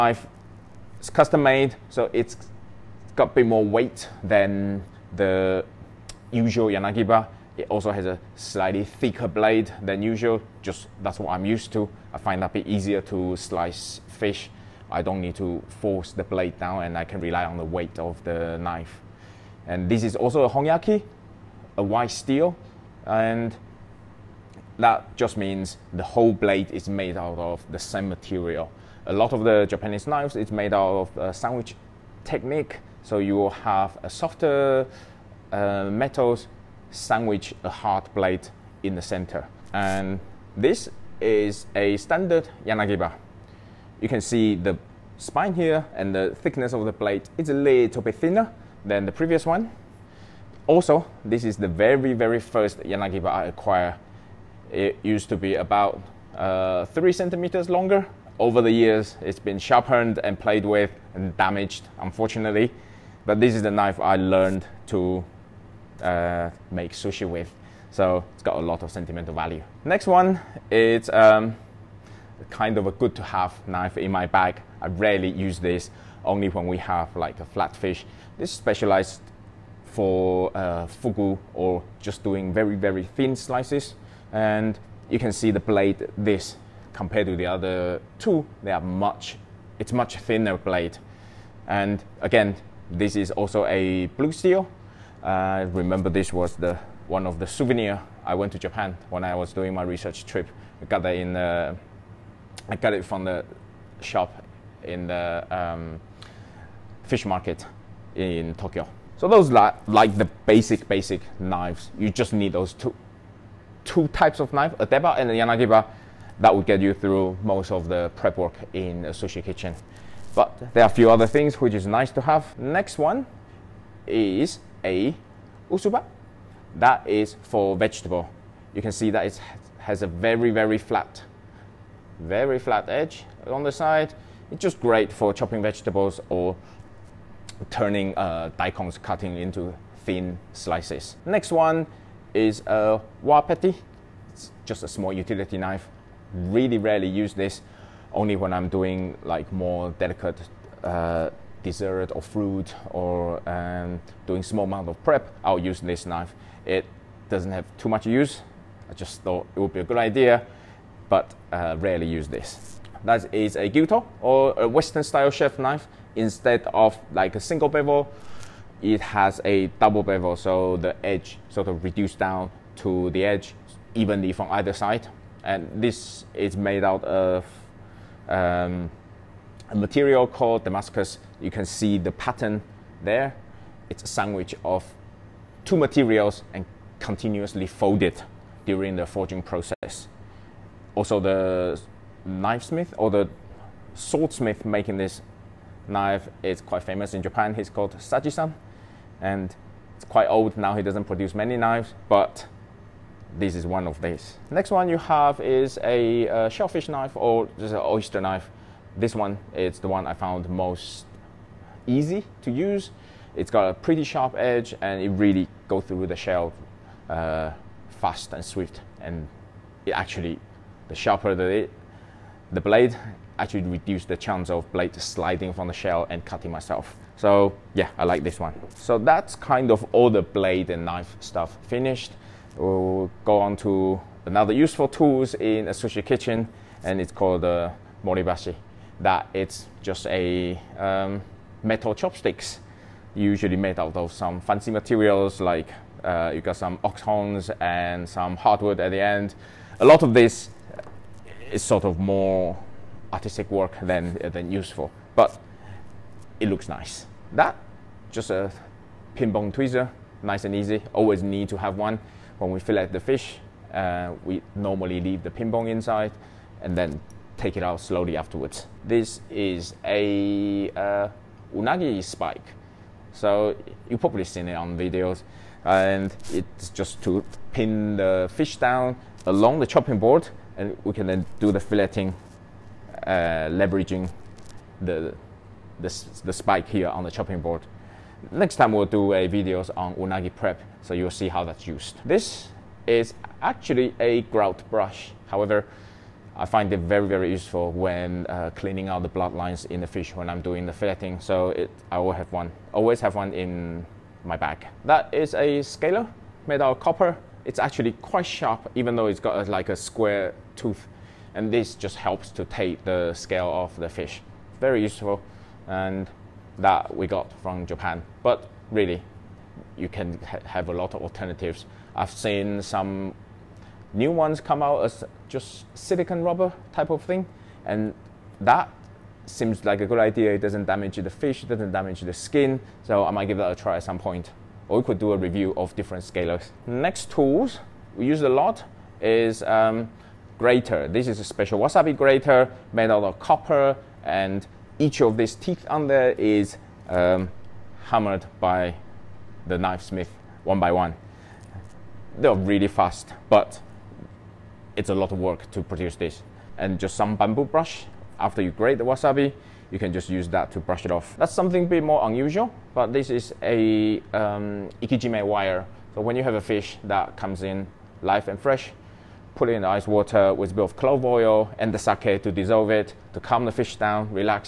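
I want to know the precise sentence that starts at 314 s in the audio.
Very useful, and that we got from Japan.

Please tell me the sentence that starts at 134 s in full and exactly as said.
It's just great for chopping vegetables or turning uh, daikons, cutting into thin slices.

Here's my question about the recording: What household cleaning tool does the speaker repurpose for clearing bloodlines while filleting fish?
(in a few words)
grout brush.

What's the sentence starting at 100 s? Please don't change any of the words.
I got that in the, I got it from the shop in the um, fish market in Tokyo.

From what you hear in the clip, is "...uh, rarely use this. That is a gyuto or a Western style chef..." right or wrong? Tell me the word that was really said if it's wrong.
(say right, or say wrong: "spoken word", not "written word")
right.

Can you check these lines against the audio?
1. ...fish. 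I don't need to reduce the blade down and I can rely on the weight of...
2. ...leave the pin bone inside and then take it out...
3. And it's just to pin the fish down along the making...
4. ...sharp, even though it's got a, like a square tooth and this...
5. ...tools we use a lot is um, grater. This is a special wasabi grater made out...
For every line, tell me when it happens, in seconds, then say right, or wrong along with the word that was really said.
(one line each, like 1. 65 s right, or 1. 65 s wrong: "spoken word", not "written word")
1. 14 s wrong: "force", not "reduce"
2. 265 s right
3. 275 s wrong: "chopping", not "making"
4. 308 s right
5. 337 s right.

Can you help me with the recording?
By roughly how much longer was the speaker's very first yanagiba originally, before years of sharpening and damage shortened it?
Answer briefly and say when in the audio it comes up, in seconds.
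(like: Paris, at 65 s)
3 centimeters, at 56 s.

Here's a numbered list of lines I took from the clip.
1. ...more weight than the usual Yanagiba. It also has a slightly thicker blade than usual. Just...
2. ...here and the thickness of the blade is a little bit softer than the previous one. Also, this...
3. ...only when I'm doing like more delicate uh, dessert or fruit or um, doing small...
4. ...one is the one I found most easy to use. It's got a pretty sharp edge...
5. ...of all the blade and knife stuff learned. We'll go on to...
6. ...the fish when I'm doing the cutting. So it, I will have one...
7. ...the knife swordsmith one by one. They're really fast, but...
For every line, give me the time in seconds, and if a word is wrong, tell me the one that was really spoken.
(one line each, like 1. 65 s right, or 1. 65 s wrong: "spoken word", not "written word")
1. 3 s right
2. 45 s wrong: "thinner", not "softer"
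3. 148 s right
4. 209 s right
5. 229 s wrong: "finished", not "learned"
6. 299 s wrong: "filleting", not "cutting"
7. 349 s wrong: "smith", not "swordsmith".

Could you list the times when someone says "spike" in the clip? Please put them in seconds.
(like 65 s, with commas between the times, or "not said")
272 s, 286 s.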